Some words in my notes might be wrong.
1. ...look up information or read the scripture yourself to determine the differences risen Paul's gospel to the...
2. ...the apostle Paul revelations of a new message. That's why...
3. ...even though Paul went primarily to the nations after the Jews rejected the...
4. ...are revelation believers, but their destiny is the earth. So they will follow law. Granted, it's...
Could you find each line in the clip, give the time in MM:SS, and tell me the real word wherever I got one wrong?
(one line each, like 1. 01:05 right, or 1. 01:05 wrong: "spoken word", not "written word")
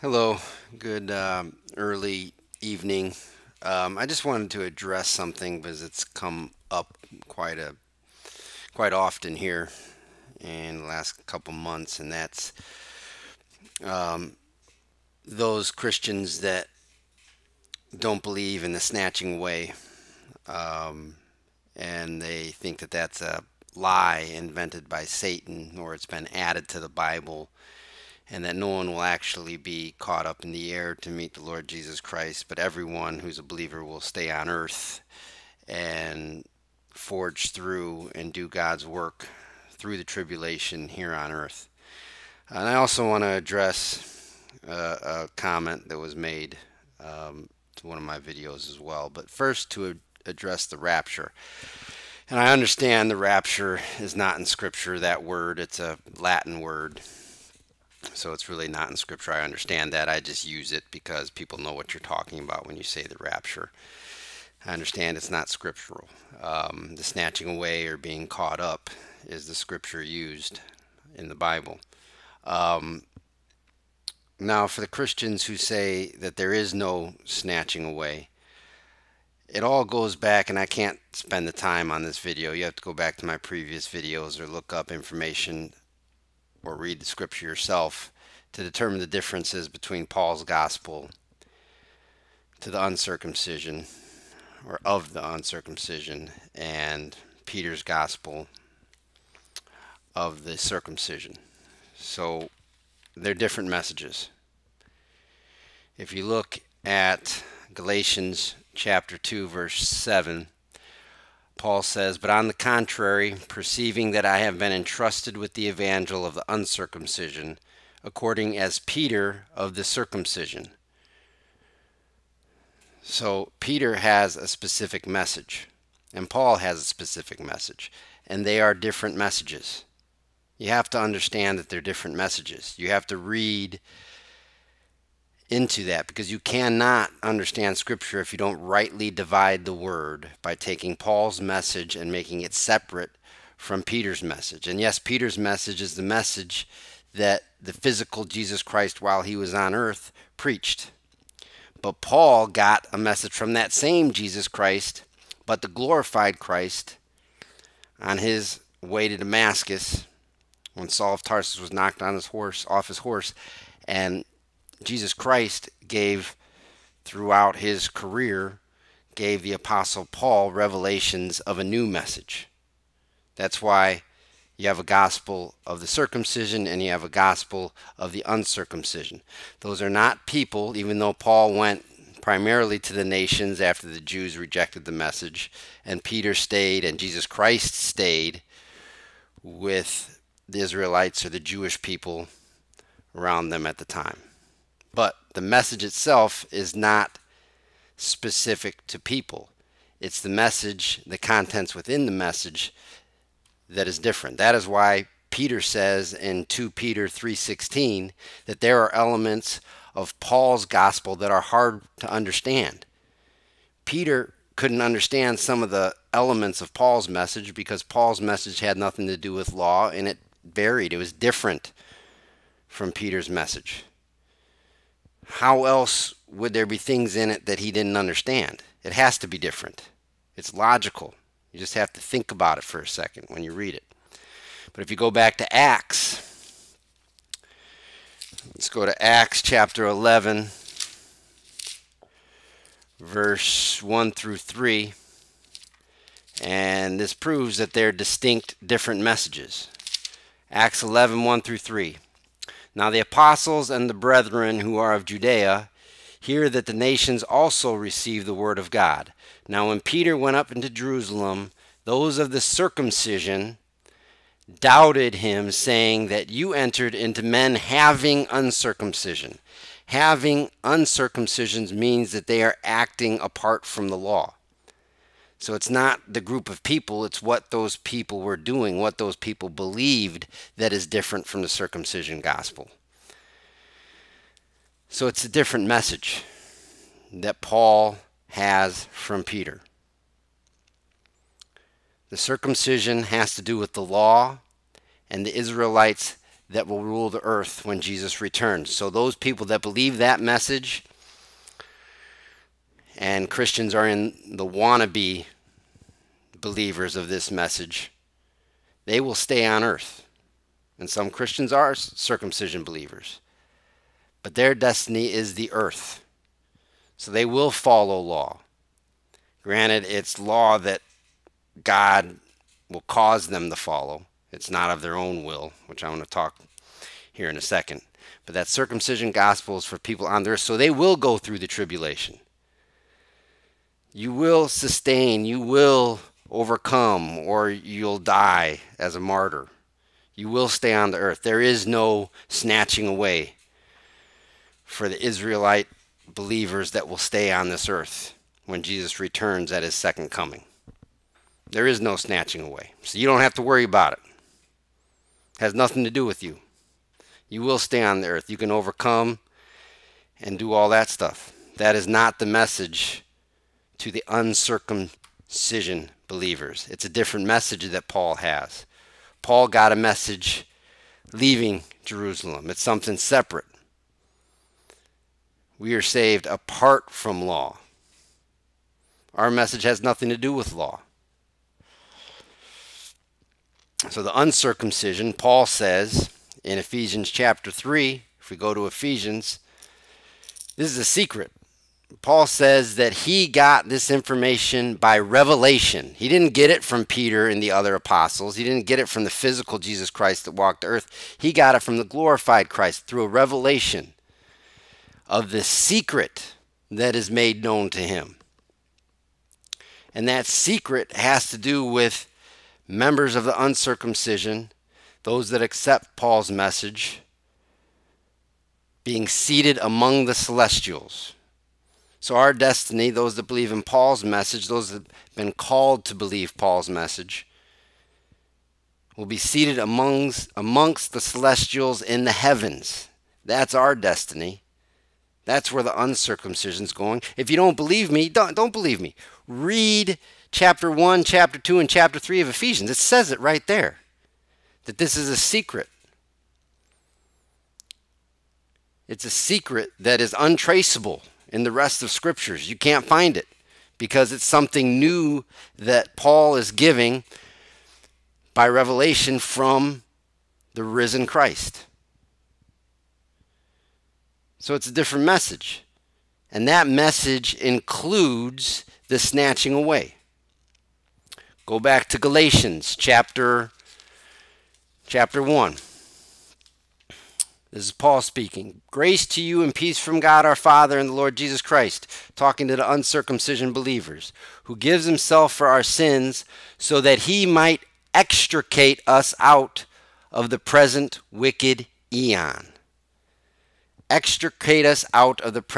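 1. 01:24 wrong: "between", not "risen"
2. 02:49 right
3. 03:00 right
4. 05:11 wrong: "circumcision", not "revelation".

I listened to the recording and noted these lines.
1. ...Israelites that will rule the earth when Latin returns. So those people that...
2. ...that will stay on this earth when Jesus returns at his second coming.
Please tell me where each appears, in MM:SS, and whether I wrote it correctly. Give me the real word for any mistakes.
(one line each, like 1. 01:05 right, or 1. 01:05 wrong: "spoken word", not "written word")
1. 04:55 wrong: "Jesus", not "Latin"
2. 05:46 right.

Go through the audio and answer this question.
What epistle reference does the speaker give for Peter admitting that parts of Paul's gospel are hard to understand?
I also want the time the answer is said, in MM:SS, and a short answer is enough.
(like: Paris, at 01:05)
2 Peter 3:16, at 03:26.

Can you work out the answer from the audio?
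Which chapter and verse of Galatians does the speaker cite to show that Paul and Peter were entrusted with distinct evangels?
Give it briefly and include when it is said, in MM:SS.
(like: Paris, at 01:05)
Chapter 2 verse 7, at 01:47.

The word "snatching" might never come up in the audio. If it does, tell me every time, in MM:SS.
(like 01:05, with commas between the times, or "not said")
00:18, 01:07, 01:17, 05:42, 05:51, 07:48.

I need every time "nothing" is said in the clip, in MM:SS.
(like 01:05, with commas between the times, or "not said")
03:38, 05:55, 06:19.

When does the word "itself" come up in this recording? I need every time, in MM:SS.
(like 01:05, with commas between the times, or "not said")
03:15.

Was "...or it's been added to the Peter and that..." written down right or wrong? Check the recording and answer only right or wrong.
wrong.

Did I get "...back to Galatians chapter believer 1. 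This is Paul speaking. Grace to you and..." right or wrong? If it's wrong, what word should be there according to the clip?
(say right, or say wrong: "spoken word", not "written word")
wrong: "chapter", not "believer".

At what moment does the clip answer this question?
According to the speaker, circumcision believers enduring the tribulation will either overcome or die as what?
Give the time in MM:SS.
05:39.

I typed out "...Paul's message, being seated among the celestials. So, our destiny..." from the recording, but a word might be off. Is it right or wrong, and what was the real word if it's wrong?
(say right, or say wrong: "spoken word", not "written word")
right.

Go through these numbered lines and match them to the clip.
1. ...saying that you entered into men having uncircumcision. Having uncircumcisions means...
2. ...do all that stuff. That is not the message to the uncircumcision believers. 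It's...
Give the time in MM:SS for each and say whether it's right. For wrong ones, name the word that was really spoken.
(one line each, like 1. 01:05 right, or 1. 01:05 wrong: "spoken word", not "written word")
1. 04:25 right
2. 06:00 right.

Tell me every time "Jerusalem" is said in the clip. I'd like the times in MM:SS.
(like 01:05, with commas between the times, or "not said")
04:20, 06:11.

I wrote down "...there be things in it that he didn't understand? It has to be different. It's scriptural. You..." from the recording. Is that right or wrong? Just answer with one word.
wrong.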